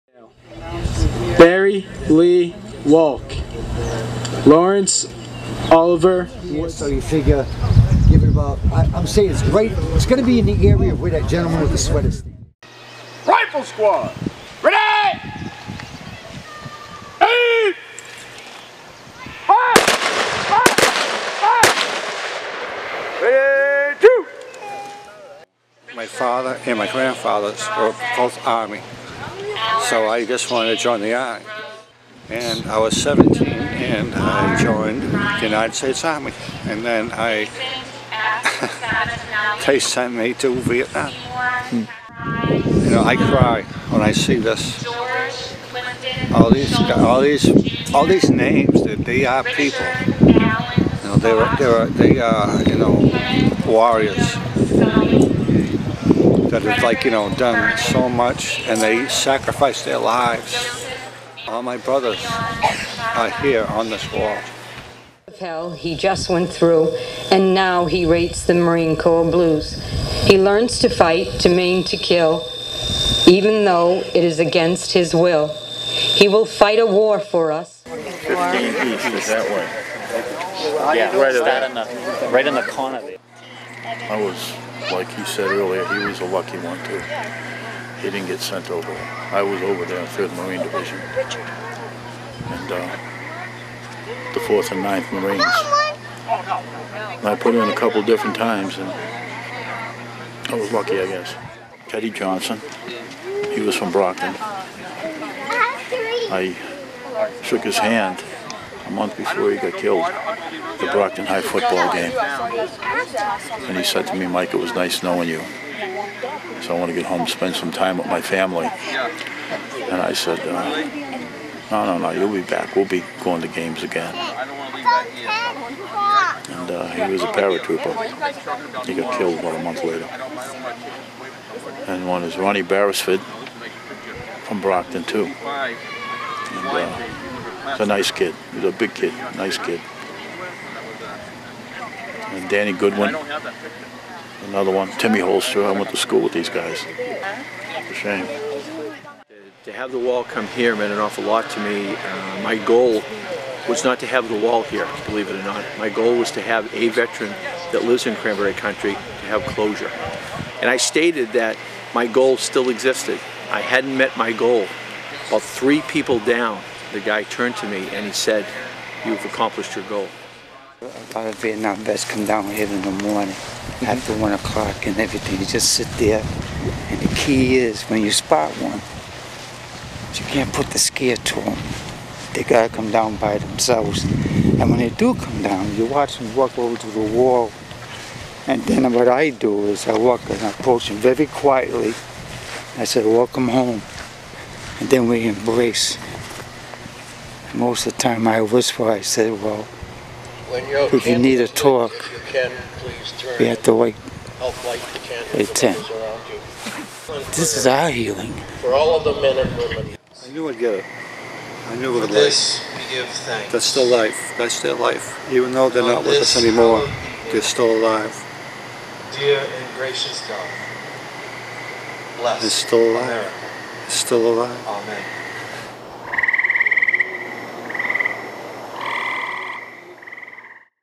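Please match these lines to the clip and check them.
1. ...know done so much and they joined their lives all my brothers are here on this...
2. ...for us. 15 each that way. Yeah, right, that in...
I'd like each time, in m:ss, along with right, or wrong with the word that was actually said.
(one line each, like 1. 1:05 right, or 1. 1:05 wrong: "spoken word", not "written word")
1. 0:57 wrong: "sacrificed", not "joined"
2. 1:17 right.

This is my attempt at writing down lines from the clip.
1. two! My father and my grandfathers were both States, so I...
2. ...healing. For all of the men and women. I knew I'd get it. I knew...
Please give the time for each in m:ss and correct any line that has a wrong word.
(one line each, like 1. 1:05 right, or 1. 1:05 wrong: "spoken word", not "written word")
1. 0:23 wrong: "Army", not "States"
2. 3:27 right.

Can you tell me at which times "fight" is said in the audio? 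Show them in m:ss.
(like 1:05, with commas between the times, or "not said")
1:10, 1:16.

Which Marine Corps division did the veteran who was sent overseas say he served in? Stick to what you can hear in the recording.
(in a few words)
3rd Marine Division.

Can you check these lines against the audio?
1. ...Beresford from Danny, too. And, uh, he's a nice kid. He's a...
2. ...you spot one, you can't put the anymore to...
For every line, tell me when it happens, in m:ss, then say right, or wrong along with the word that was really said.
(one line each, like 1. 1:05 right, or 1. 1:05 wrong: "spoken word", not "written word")
1. 2:12 wrong: "Brockton", not "Danny"
2. 2:58 wrong: "scare", not "anymore".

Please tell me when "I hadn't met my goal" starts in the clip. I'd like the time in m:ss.
2:43.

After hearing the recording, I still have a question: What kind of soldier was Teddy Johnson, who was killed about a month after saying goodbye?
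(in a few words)
Paratrooper.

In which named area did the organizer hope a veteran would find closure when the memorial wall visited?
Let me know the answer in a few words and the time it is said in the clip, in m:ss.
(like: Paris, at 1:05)
Cranberry Country, at 2:38.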